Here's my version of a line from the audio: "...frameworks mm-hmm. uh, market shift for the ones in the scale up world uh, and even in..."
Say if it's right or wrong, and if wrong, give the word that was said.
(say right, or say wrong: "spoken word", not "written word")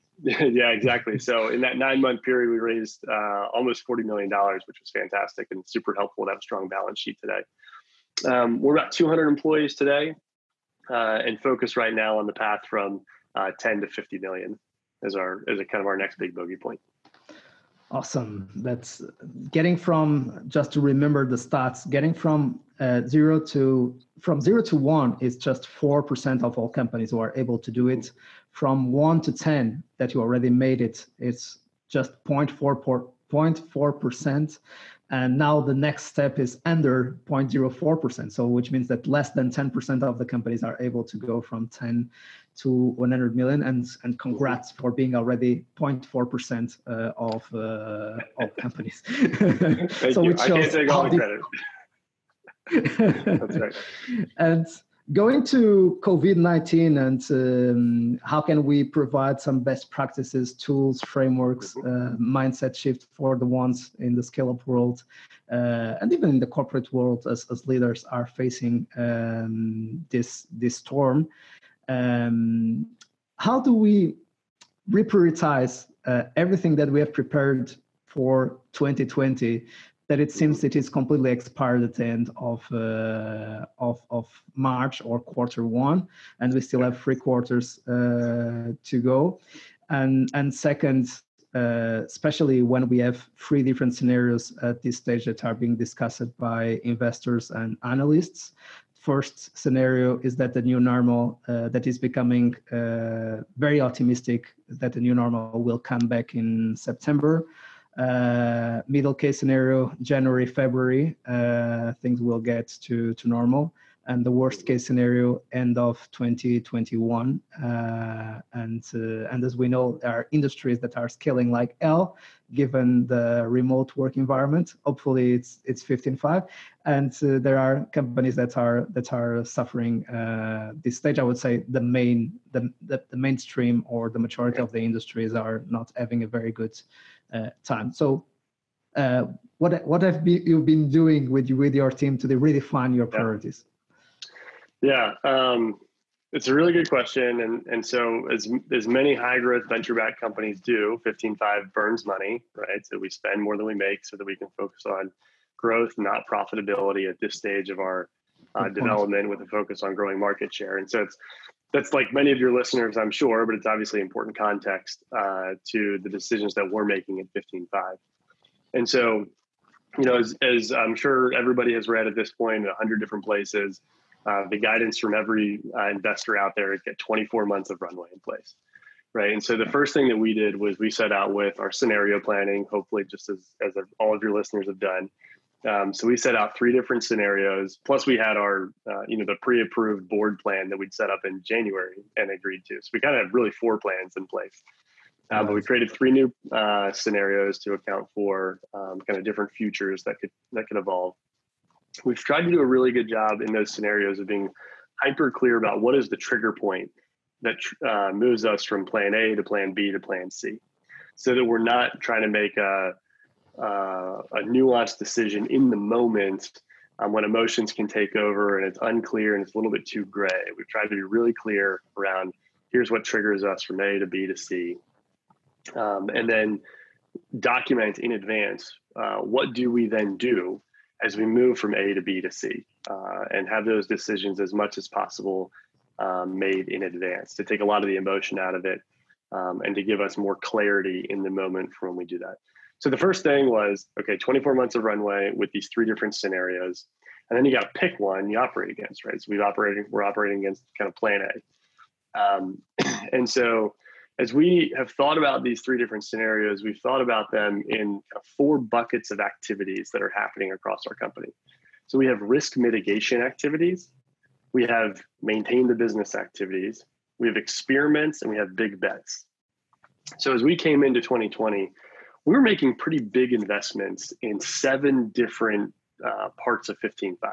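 wrong: "mindset", not "market".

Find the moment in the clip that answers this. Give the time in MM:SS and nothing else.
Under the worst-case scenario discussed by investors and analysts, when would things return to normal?
01:55.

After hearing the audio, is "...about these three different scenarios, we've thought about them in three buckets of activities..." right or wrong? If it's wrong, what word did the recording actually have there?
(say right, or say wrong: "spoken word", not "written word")
wrong: "four", not "three".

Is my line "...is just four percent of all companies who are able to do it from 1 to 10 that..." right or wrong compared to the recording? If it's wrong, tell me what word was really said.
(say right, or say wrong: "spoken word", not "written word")
right.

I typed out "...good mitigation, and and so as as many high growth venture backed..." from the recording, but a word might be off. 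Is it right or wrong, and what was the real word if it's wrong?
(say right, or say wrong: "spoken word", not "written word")
wrong: "question", not "mitigation".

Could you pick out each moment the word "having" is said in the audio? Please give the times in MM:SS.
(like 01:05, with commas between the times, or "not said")
02:15.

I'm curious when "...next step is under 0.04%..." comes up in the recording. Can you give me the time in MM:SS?
00:35.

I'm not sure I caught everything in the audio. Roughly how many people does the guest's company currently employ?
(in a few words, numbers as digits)
200.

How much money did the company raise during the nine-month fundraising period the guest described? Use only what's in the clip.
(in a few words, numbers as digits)
almost $40 million.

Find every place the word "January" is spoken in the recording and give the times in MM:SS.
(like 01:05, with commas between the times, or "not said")
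01:49, 03:11.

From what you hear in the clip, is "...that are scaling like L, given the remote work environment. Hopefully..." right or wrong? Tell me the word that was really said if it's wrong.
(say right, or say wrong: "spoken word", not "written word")
right.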